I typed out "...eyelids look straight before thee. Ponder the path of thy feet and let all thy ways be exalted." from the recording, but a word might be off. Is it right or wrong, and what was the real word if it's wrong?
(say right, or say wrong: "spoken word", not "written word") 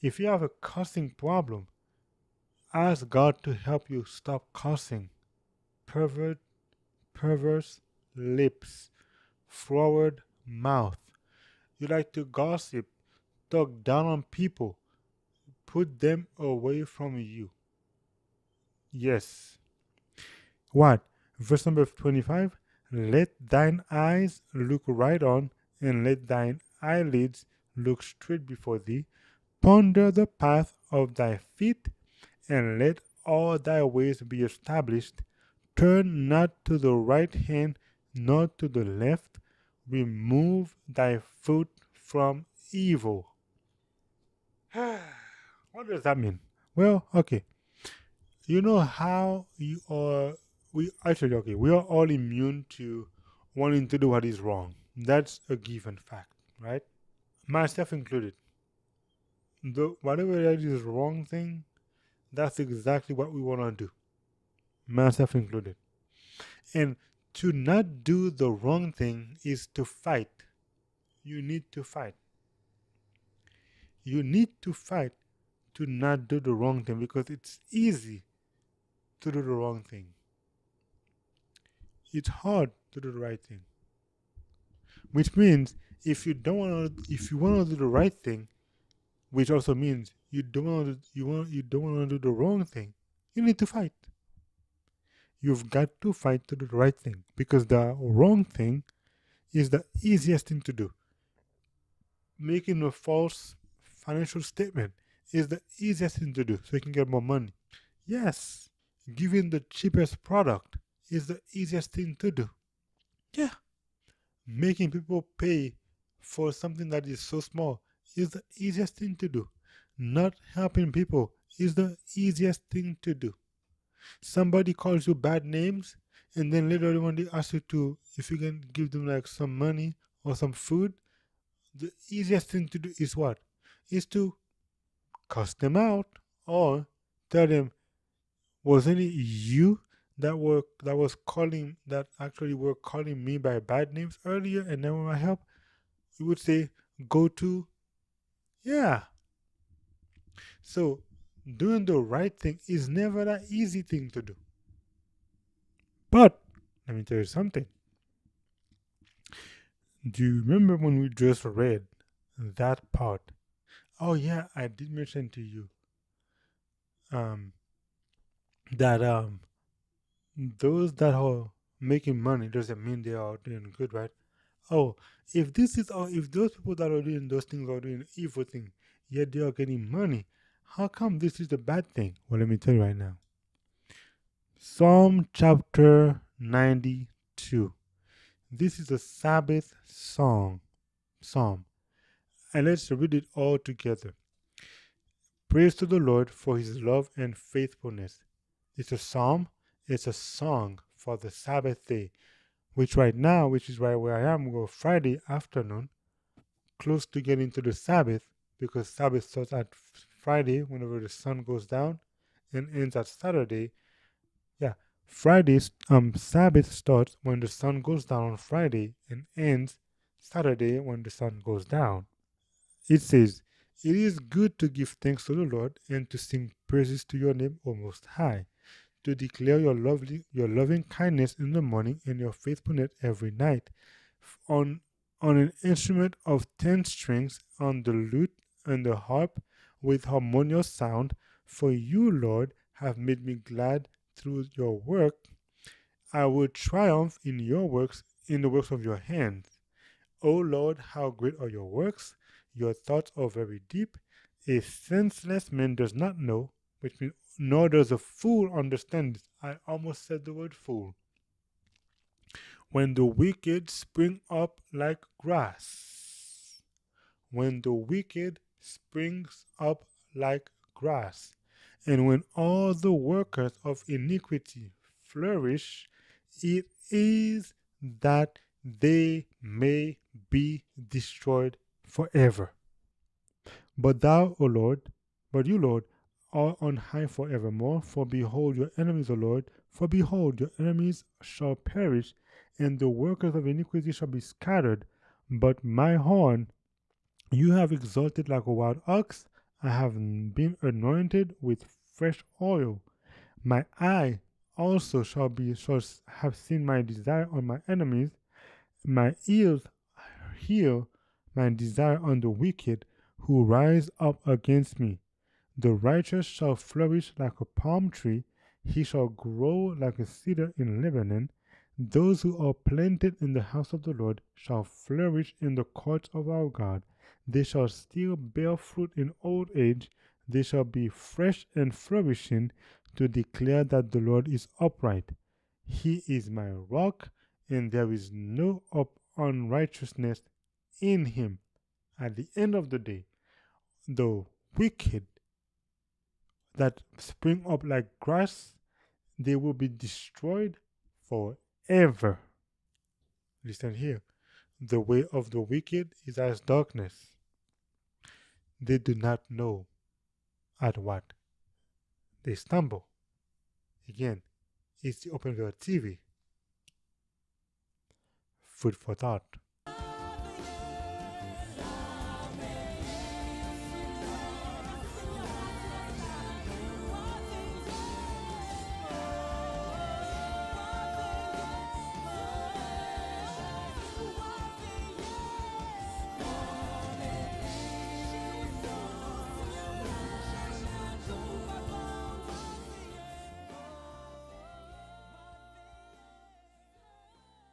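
wrong: "established", not "exalted".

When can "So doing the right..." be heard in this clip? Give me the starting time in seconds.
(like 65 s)
150 s.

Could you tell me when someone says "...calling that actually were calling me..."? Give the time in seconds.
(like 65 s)
141 s.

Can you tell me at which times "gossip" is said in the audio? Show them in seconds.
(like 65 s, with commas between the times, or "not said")
12 s.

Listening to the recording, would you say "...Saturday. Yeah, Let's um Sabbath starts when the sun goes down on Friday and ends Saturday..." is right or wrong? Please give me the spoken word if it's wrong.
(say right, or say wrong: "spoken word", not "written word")
wrong: "Friday", not "Let".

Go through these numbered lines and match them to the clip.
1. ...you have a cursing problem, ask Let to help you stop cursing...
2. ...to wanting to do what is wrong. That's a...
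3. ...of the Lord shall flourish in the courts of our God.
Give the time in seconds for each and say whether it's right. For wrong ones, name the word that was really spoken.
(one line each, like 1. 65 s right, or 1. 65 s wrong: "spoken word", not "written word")
1. 0 s wrong: "God", not "Let"
2. 52 s right
3. 323 s right.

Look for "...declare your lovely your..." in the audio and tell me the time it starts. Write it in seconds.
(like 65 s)
229 s.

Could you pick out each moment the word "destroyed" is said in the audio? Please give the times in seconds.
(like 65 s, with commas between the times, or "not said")
280 s, 349 s.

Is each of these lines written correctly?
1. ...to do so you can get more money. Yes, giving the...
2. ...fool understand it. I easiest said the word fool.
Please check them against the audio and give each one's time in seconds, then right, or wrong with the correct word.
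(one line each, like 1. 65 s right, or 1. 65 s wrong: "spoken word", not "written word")
1. 106 s right
2. 257 s wrong: "almost", not "easiest".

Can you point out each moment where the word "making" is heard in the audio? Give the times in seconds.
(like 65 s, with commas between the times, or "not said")
102 s, 114 s, 171 s.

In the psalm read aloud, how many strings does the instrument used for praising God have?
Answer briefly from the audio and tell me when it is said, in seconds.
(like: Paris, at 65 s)
10, at 236 s.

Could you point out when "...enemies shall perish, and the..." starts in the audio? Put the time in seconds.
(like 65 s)
290 s.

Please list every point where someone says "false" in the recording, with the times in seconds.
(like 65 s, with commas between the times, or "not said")
102 s.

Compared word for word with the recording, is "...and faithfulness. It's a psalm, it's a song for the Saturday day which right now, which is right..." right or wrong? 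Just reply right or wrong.
wrong.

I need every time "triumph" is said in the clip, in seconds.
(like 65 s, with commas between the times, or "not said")
246 s.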